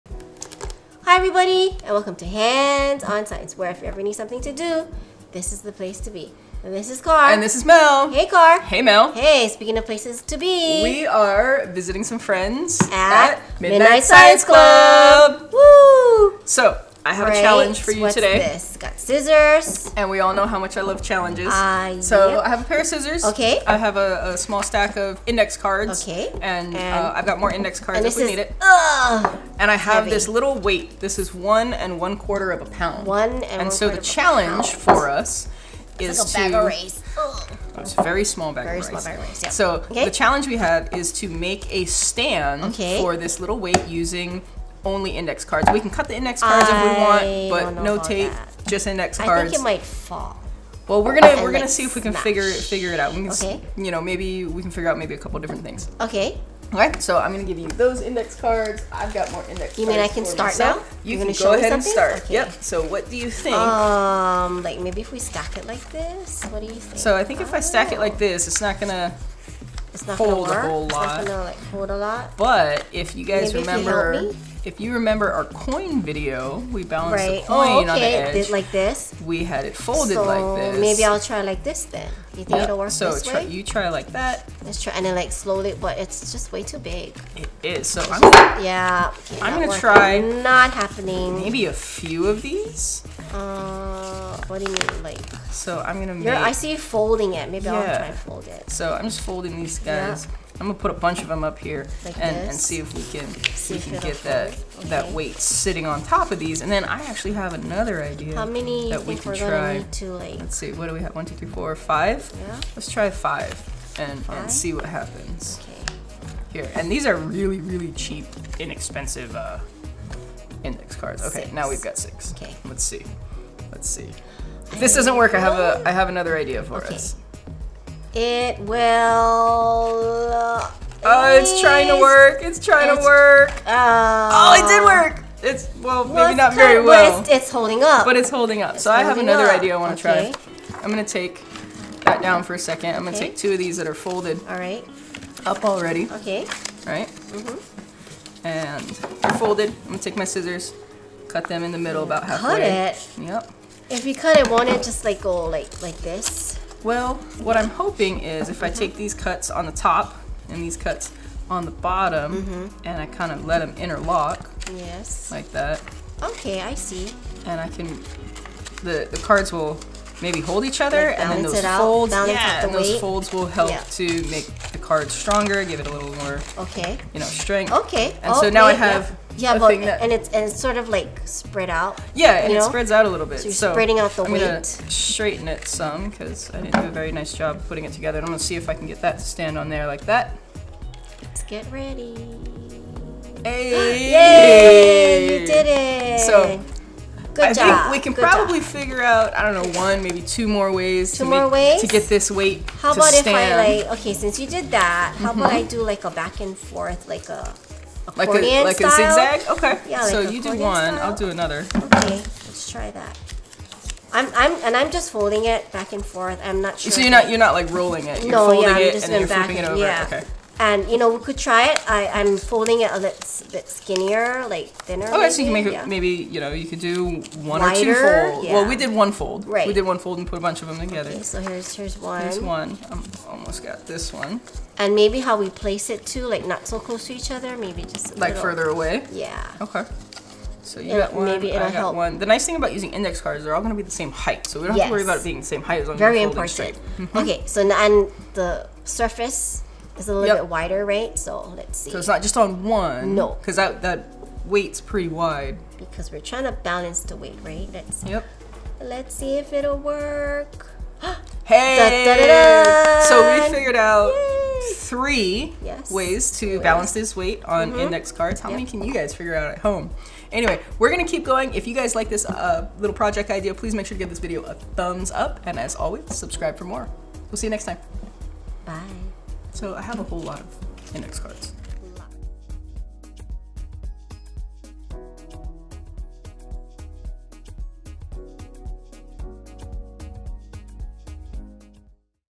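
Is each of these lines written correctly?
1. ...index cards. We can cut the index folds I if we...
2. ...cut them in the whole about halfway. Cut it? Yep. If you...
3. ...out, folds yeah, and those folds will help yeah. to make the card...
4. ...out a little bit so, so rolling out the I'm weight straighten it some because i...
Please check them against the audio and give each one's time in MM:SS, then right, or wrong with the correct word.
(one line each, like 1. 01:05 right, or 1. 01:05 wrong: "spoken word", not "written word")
1. 00:45 wrong: "cards", not "folds"
2. 02:31 wrong: "middle", not "whole"
3. 02:51 right
4. 03:02 wrong: "spreading", not "rolling".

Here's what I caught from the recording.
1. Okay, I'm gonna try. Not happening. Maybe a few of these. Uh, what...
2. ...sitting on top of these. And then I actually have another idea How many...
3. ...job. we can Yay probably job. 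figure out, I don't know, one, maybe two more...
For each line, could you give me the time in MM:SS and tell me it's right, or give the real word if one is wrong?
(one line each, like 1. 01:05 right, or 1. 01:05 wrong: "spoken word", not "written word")
1. 01:29 right
2. 01:45 right
3. 03:17 wrong: "Good", not "Yay".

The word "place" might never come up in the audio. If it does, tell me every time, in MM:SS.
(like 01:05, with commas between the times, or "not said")
00:05, 00:09, 03:55.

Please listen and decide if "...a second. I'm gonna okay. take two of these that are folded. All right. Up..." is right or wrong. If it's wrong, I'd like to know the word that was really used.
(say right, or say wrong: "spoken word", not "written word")
right.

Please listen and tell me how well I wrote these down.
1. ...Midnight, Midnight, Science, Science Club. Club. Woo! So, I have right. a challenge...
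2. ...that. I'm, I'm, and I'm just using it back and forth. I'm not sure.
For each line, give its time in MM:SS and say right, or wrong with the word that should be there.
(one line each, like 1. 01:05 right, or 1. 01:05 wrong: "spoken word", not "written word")
1. 00:13 right
2. 03:32 wrong: "folding", not "using".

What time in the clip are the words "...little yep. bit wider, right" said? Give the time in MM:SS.
04:10.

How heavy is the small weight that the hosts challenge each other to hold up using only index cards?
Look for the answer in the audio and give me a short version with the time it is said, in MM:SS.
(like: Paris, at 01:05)
1 1/4 pounds, at 00:31.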